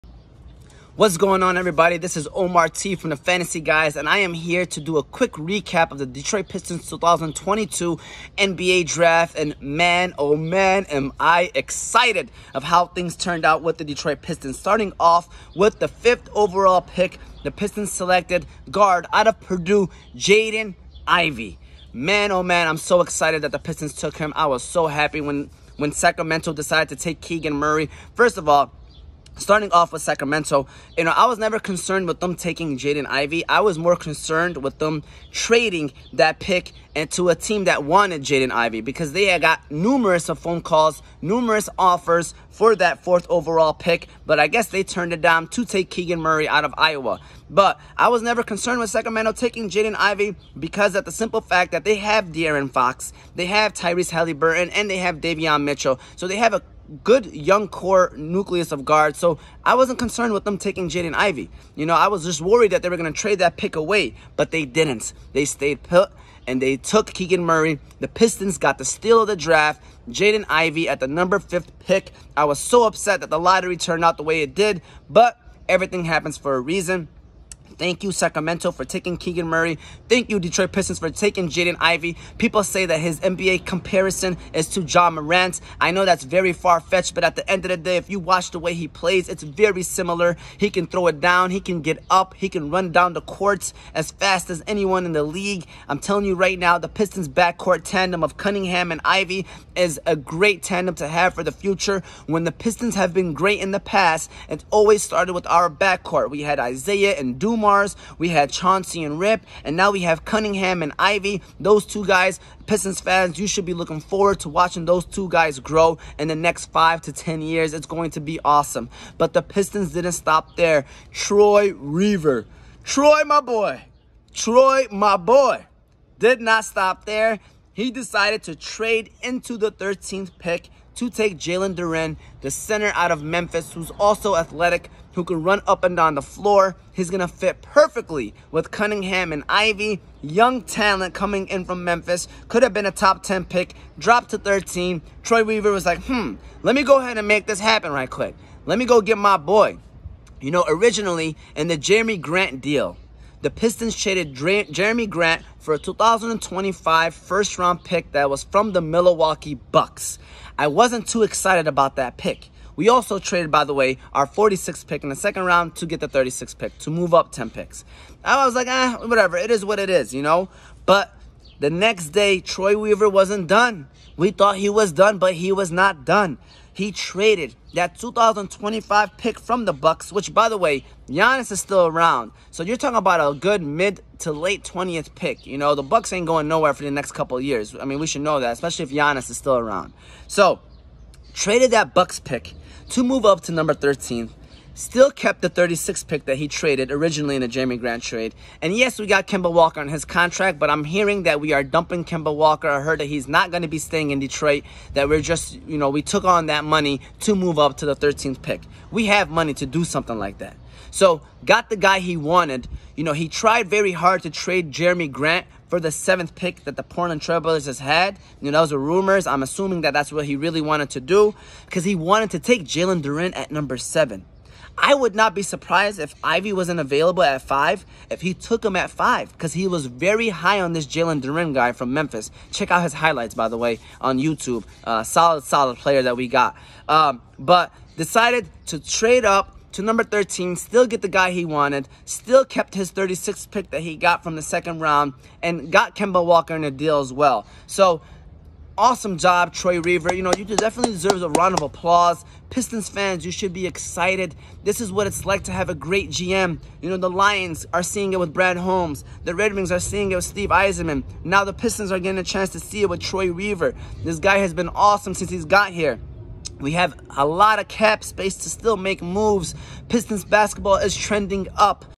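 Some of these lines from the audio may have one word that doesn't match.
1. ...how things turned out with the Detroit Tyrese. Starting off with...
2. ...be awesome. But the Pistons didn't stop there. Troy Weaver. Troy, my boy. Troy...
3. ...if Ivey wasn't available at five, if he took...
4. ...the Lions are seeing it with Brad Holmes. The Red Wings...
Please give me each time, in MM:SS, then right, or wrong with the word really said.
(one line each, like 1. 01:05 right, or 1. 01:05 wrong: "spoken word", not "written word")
1. 00:12 wrong: "Pistons", not "Tyrese"
2. 01:58 right
3. 03:45 right
4. 04:16 right.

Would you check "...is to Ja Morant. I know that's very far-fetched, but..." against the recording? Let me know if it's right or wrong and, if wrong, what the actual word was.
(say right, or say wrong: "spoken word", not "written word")
right.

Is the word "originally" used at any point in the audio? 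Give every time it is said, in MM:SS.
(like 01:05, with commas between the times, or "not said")
02:30, 03:16.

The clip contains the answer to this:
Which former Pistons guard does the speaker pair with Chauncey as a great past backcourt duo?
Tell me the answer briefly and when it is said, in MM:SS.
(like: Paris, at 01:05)
Rip, at 01:49.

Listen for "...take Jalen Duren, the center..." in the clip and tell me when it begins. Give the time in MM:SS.
02:11.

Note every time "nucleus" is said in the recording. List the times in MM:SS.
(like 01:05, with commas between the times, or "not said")
00:58.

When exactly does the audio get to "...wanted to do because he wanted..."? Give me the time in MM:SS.
03:40.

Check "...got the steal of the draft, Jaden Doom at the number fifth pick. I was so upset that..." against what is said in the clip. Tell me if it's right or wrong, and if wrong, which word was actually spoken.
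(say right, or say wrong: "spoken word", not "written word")
wrong: "Ivey", not "Doom".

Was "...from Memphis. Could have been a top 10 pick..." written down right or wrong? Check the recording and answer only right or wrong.
right.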